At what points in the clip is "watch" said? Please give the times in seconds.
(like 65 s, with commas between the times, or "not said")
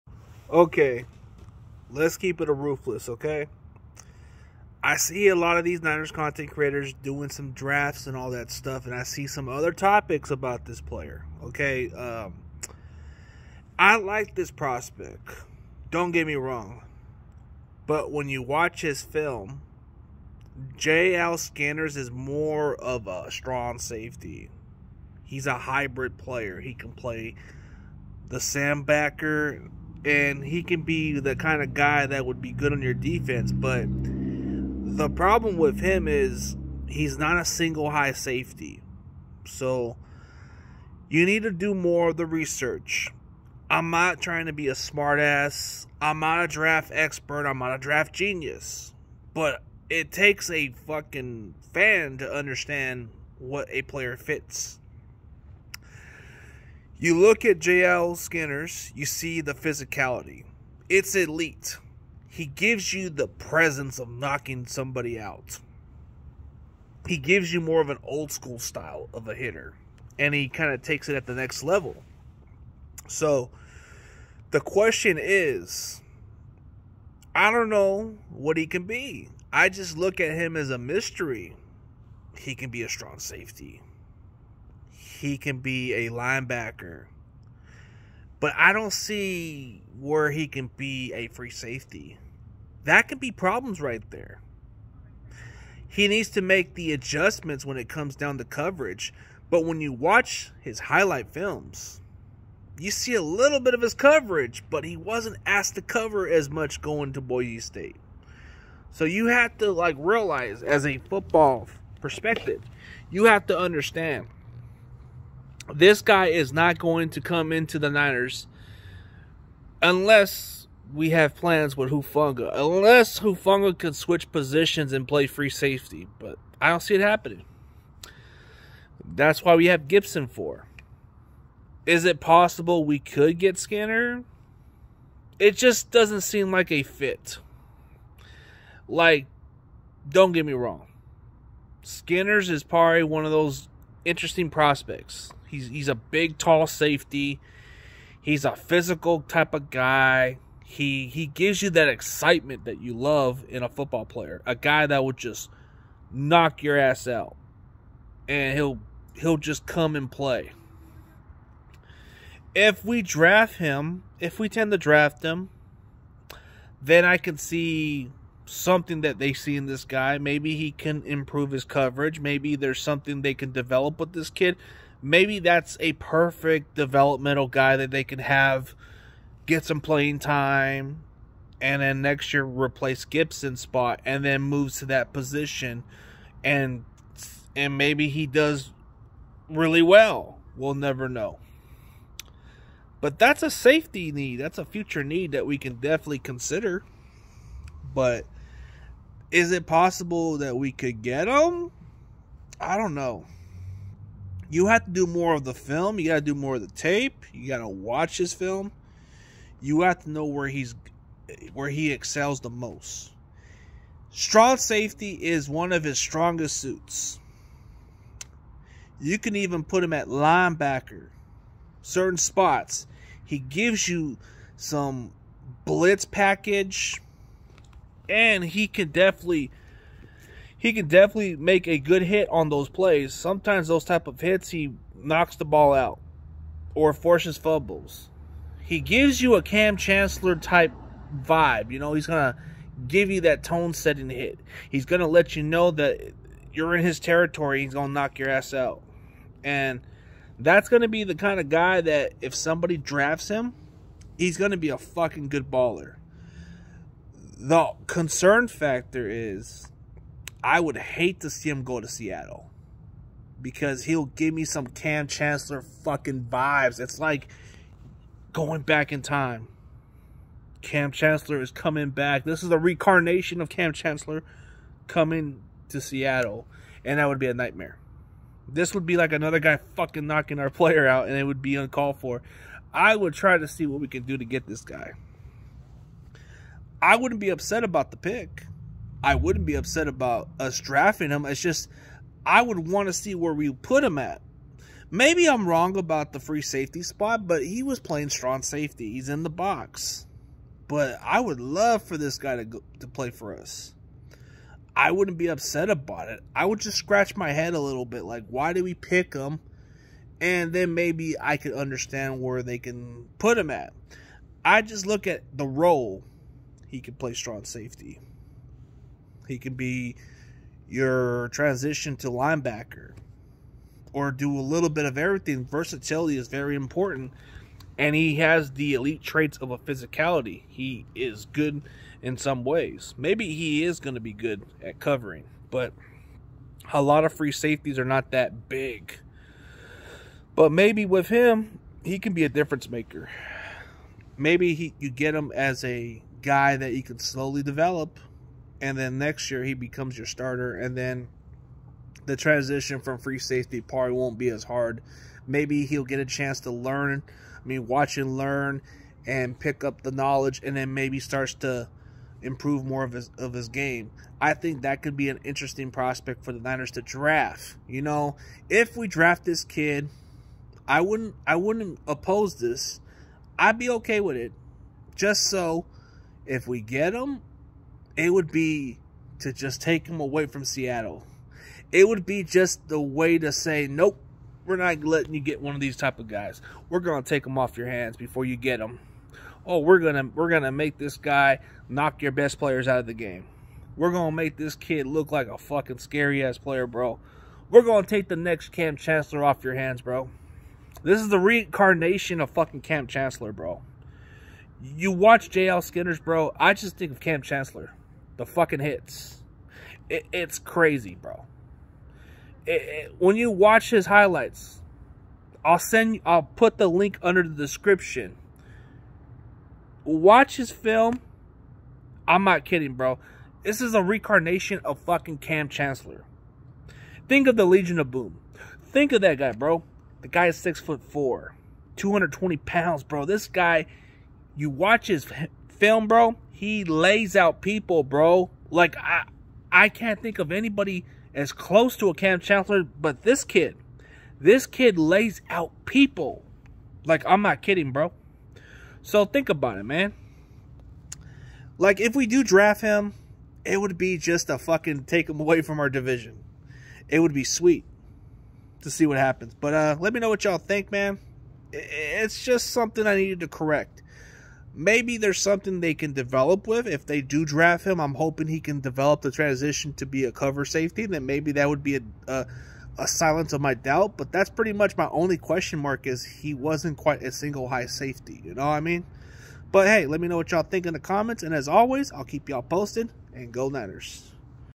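18 s, 99 s, 207 s, 357 s, 404 s, 413 s, 419 s, 434 s.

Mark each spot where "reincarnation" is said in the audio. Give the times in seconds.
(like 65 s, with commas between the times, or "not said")
272 s, 401 s, 423 s.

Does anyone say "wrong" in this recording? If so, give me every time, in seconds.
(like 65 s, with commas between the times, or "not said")
16 s, 140 s, 295 s.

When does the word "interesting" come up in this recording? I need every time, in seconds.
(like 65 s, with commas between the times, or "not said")
144 s, 365 s.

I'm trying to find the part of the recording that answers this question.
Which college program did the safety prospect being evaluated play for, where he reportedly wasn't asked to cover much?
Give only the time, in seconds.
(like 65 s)
107 s.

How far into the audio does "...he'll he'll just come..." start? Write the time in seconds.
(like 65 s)
158 s.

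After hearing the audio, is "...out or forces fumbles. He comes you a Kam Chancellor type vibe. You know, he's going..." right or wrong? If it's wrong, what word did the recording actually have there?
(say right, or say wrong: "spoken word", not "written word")
wrong: "gives", not "comes".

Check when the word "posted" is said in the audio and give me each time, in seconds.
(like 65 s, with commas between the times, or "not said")
482 s.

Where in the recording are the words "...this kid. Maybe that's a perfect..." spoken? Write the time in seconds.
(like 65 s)
174 s.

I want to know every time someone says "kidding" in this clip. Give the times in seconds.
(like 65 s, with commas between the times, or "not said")
422 s, 447 s.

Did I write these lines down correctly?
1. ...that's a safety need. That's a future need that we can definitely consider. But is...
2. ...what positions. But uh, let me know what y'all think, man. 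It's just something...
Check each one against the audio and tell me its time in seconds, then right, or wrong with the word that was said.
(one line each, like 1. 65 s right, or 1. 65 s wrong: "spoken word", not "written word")
1. 193 s right
2. 458 s wrong: "happens", not "positions".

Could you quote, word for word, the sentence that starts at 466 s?
If they do draft him, I'm hoping he can develop the transition to be a cover safety.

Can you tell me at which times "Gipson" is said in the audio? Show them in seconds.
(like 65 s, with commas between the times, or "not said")
129 s, 183 s.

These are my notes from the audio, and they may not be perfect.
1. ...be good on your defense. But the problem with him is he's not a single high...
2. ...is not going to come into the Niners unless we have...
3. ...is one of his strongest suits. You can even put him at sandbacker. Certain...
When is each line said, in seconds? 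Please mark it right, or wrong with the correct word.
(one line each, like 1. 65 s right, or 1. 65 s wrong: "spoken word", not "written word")
1. 32 s right
2. 116 s right
3. 215 s wrong: "linebacker", not "sandbacker".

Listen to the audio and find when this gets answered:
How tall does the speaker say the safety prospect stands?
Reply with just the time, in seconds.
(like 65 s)
430 s.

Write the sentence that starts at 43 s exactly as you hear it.
I'm not trying to be a smartass.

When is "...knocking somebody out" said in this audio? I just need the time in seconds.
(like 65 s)
64 s.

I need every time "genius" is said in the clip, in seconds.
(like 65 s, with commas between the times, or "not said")
48 s.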